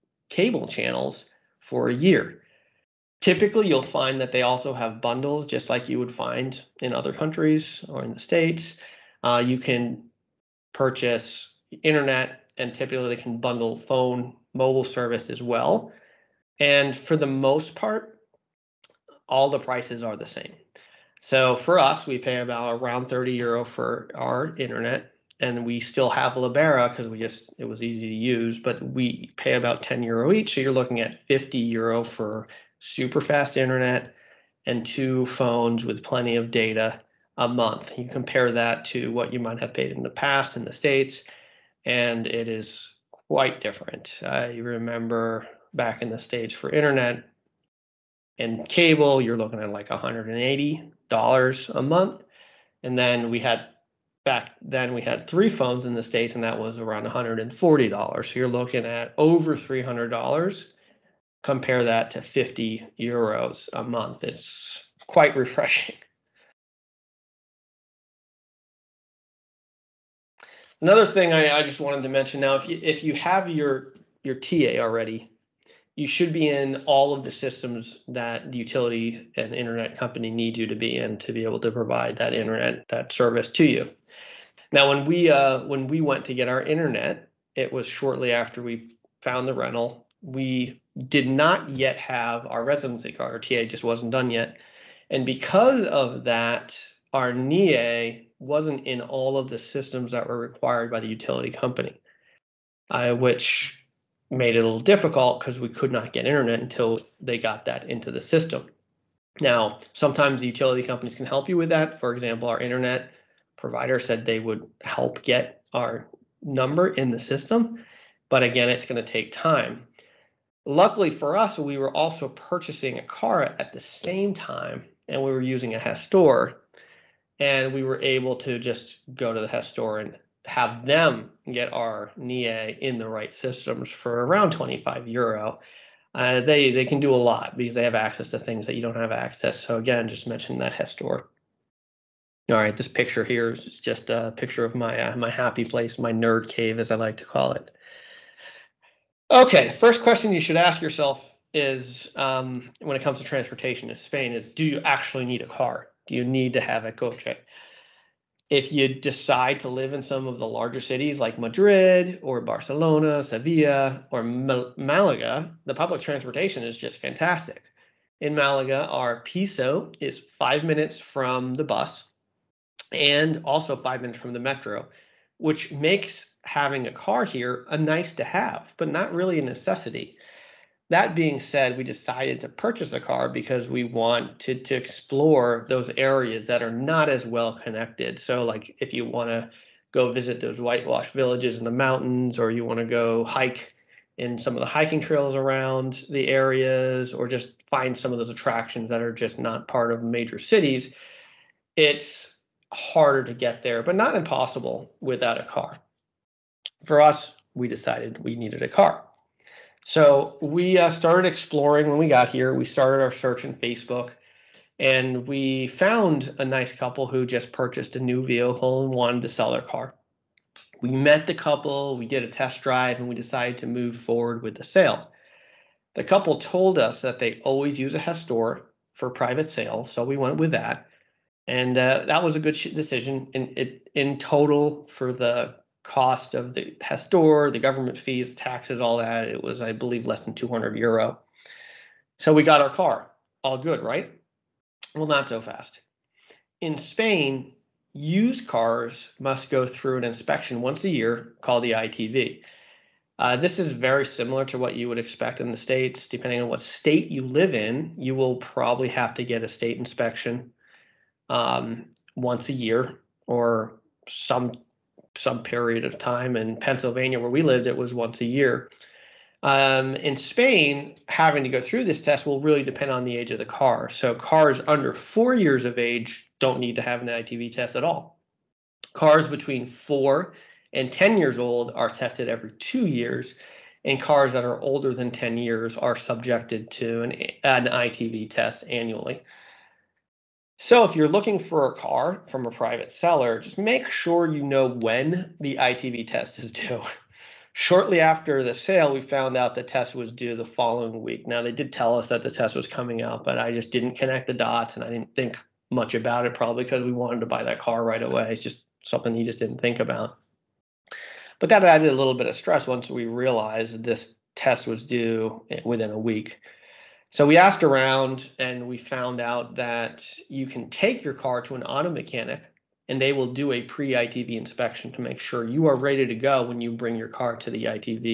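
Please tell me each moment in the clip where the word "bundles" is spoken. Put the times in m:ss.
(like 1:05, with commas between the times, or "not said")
0:04, 0:13.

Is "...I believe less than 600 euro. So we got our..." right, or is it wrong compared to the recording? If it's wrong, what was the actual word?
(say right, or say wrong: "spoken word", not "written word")
wrong: "200", not "600".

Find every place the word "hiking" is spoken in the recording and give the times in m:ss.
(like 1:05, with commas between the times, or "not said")
3:14.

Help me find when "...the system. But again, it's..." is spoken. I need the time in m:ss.
1:57.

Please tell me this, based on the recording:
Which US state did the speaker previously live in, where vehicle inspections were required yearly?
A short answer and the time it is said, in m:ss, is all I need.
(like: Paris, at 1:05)
Pennsylvania, at 4:26.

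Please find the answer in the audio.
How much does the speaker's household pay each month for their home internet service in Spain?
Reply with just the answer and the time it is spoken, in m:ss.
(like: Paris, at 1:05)
30 euro, at 0:23.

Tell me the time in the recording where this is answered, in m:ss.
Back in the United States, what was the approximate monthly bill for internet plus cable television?
0:49.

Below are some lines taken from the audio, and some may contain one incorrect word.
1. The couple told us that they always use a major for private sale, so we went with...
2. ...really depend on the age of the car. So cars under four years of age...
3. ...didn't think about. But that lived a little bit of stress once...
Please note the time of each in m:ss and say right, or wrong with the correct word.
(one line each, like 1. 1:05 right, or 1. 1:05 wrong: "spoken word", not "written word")
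1. 3:45 wrong: "gestor", not "major"
2. 4:32 right
3. 5:09 wrong: "added", not "lived".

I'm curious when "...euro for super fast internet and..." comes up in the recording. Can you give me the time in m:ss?
0:31.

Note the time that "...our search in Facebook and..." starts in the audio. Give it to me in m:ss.
3:33.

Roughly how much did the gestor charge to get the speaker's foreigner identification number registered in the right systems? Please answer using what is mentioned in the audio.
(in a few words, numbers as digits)
25 euro.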